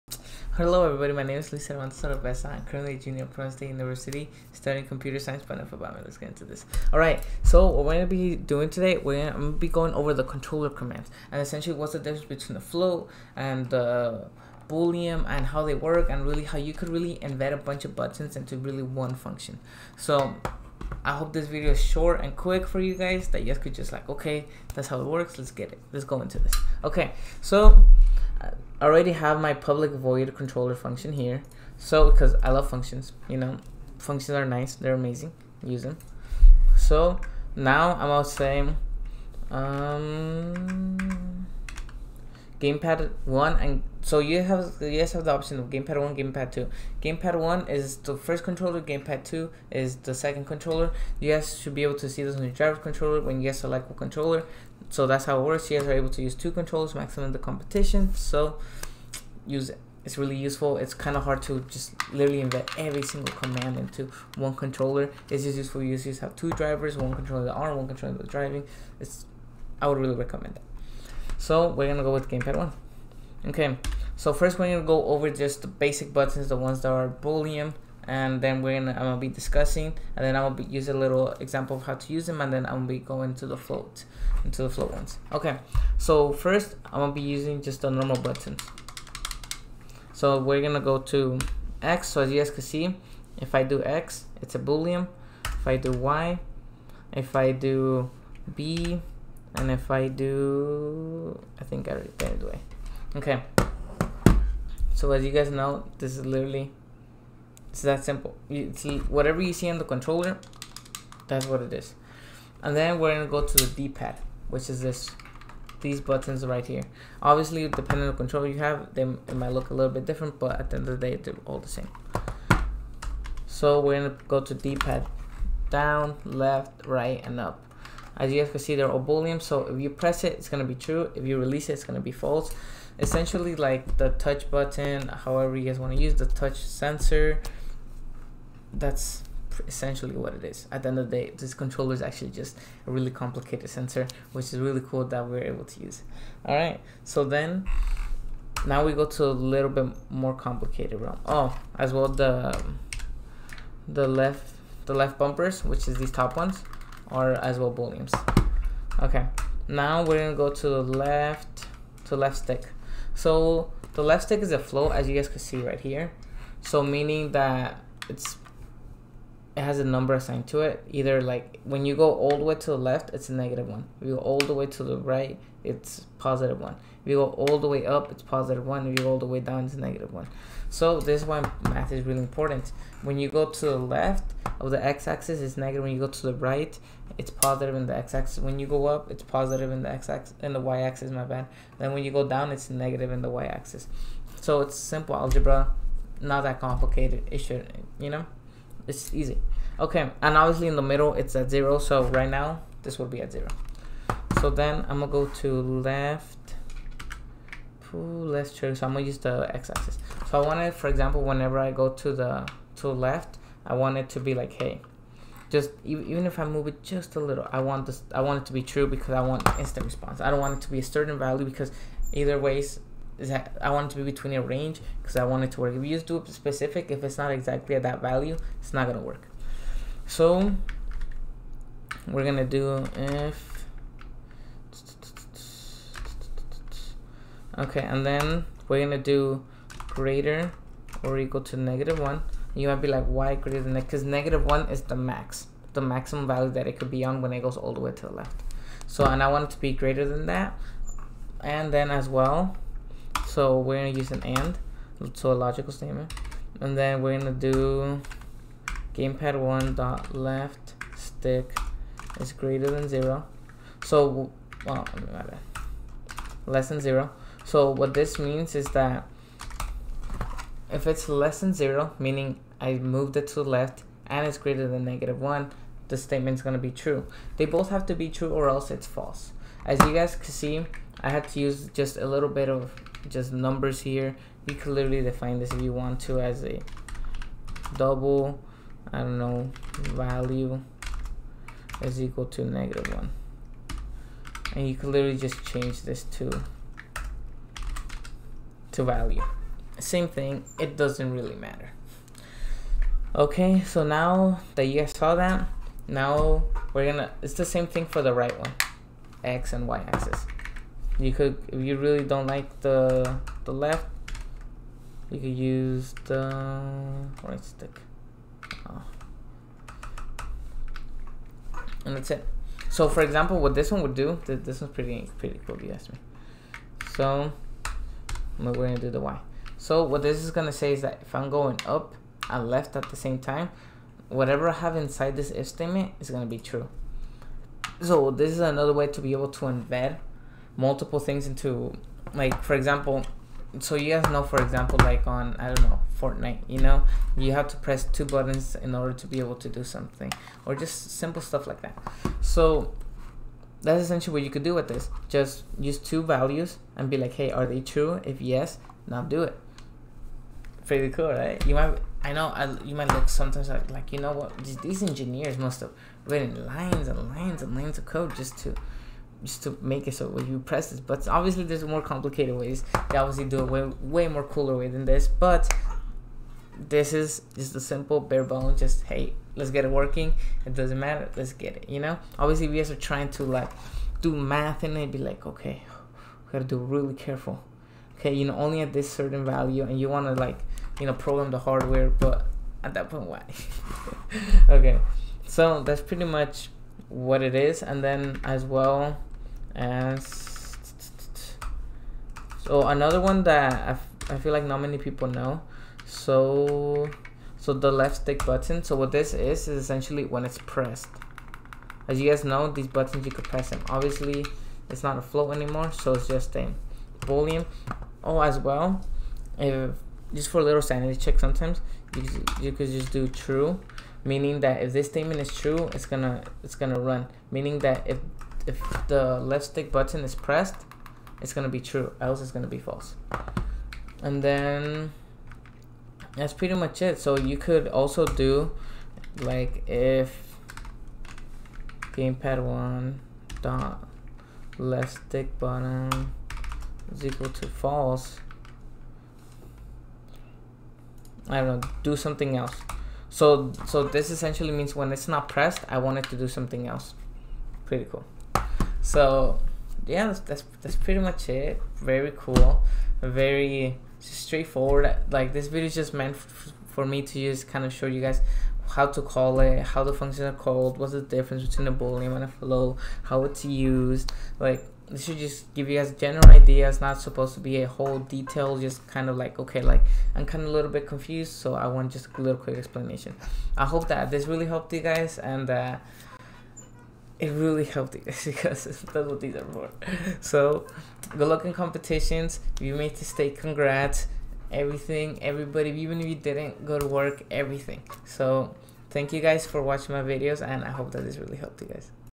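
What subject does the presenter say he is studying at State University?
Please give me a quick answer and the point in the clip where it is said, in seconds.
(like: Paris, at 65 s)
Computer science, at 4 s.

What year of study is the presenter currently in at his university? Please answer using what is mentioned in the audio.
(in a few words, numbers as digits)
Junior.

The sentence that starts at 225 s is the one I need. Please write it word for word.
If you just do it specific, if it's not exactly at that value, it's not gonna work.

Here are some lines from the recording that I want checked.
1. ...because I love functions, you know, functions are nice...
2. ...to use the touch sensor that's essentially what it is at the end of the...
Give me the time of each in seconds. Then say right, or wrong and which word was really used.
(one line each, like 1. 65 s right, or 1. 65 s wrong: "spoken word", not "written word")
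1. 32 s right
2. 135 s right.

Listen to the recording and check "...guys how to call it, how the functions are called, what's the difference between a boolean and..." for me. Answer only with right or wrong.
right.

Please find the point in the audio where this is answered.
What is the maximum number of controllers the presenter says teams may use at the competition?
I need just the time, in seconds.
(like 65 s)
56 s.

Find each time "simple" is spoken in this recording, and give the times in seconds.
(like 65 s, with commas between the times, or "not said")
108 s, 194 s, 350 s, 377 s.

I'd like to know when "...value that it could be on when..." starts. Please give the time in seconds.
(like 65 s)
246 s.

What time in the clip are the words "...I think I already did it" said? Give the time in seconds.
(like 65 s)
101 s.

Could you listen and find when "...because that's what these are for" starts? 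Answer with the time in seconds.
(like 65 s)
488 s.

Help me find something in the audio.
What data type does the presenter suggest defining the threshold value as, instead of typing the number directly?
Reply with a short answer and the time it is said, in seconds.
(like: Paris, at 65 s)
Double, at 287 s.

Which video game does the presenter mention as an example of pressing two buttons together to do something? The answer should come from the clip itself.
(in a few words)
Fortnite.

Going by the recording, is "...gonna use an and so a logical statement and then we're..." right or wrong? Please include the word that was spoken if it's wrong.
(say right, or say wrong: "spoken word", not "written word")
right.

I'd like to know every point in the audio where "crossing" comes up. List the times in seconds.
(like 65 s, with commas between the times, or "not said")
not said.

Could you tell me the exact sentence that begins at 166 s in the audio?
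So meaning that it's it has a number assigned to it.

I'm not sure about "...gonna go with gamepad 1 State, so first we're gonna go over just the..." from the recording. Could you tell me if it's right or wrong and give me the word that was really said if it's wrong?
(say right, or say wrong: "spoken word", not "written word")
wrong: "Okay", not "State".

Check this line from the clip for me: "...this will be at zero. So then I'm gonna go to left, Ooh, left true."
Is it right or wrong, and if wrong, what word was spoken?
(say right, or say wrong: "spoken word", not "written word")
right.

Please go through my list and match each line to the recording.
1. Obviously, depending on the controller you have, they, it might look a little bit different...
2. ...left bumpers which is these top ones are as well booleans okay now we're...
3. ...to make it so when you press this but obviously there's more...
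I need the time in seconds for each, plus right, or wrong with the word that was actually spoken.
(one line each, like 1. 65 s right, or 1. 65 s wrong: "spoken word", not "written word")
1. 117 s right
2. 154 s right
3. 369 s right.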